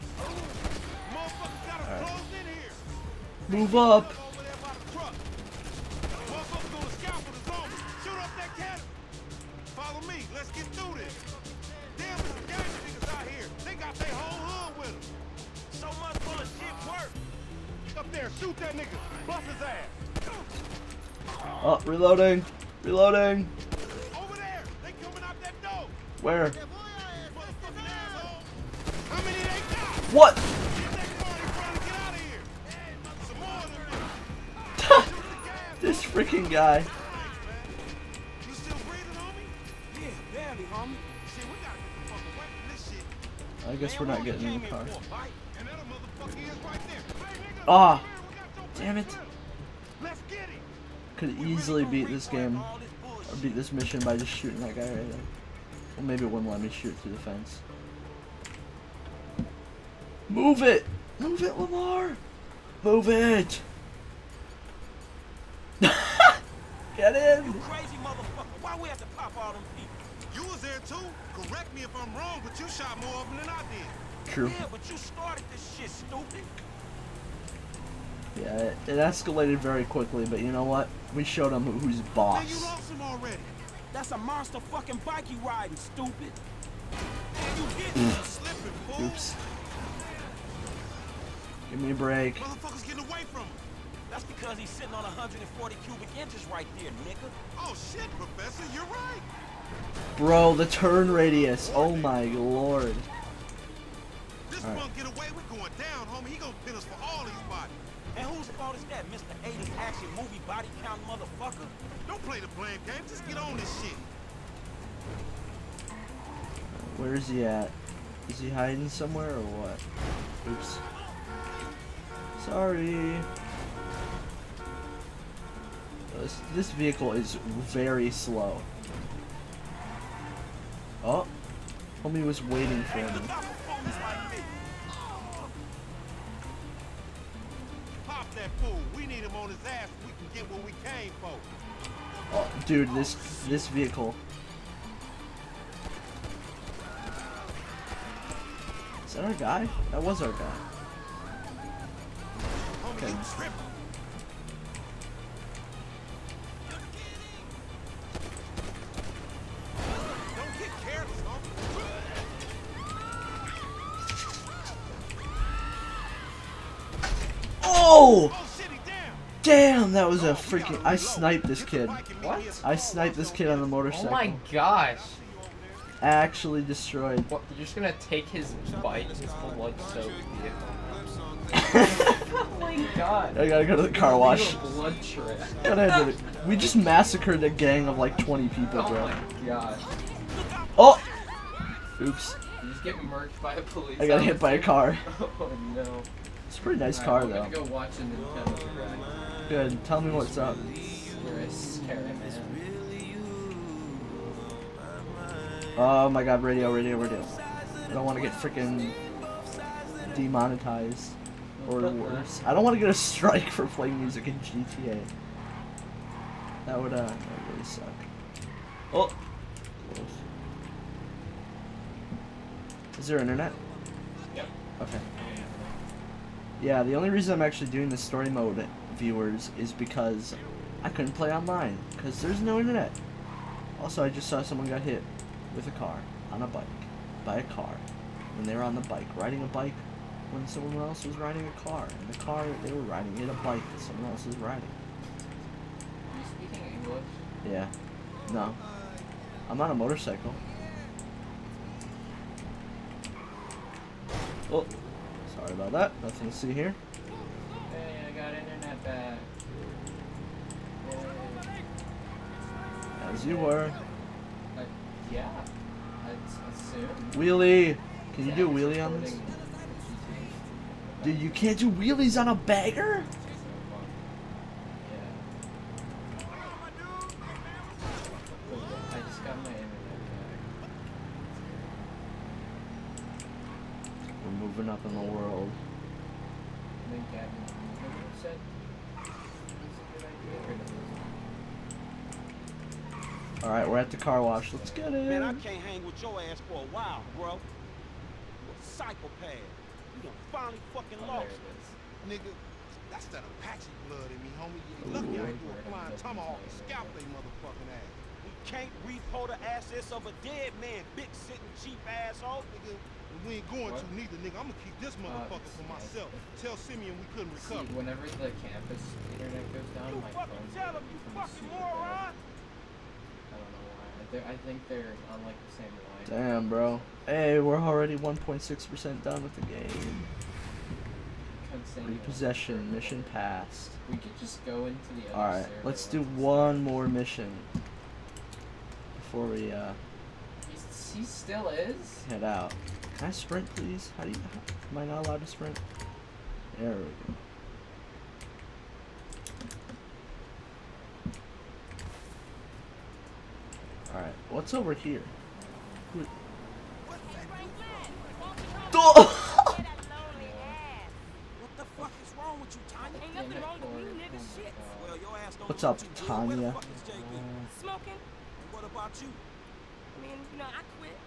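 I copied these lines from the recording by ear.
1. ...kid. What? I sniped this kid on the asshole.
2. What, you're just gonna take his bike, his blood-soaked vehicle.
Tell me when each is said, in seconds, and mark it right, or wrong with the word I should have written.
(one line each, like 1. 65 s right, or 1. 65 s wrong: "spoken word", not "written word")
1. 171 s wrong: "motorcycle", not "asshole"
2. 177 s right.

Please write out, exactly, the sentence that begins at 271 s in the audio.
Dude, you can't do wheelies on a bagger?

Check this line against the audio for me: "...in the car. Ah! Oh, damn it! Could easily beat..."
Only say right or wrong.
right.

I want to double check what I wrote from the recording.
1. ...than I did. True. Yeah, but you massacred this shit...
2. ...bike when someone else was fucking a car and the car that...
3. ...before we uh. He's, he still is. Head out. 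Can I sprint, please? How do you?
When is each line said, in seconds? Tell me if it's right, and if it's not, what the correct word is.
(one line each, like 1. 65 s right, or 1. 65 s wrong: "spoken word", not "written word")
1. 73 s wrong: "started", not "massacred"
2. 239 s wrong: "riding", not "fucking"
3. 338 s right.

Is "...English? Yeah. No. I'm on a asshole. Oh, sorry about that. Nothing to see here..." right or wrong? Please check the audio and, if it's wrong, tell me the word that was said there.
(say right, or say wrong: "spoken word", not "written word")
wrong: "motorcycle", not "asshole".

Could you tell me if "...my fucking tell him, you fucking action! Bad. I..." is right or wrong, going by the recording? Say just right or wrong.
wrong.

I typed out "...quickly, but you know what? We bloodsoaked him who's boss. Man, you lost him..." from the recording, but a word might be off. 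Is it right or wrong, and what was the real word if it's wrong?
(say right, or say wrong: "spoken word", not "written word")
wrong: "showed", not "bloodsoaked".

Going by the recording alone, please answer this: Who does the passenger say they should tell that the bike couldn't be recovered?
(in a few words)
Simeon.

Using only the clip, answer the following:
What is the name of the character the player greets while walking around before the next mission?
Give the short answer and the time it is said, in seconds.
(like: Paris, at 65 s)
Tanya, at 365 s.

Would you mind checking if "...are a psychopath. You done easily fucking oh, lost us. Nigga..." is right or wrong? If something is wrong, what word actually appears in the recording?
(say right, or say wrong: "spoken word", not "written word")
wrong: "finally", not "easily".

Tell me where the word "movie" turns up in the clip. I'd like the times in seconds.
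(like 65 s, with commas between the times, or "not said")
110 s.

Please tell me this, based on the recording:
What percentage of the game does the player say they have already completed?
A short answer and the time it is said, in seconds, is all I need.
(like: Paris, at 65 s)
1.6%, at 327 s.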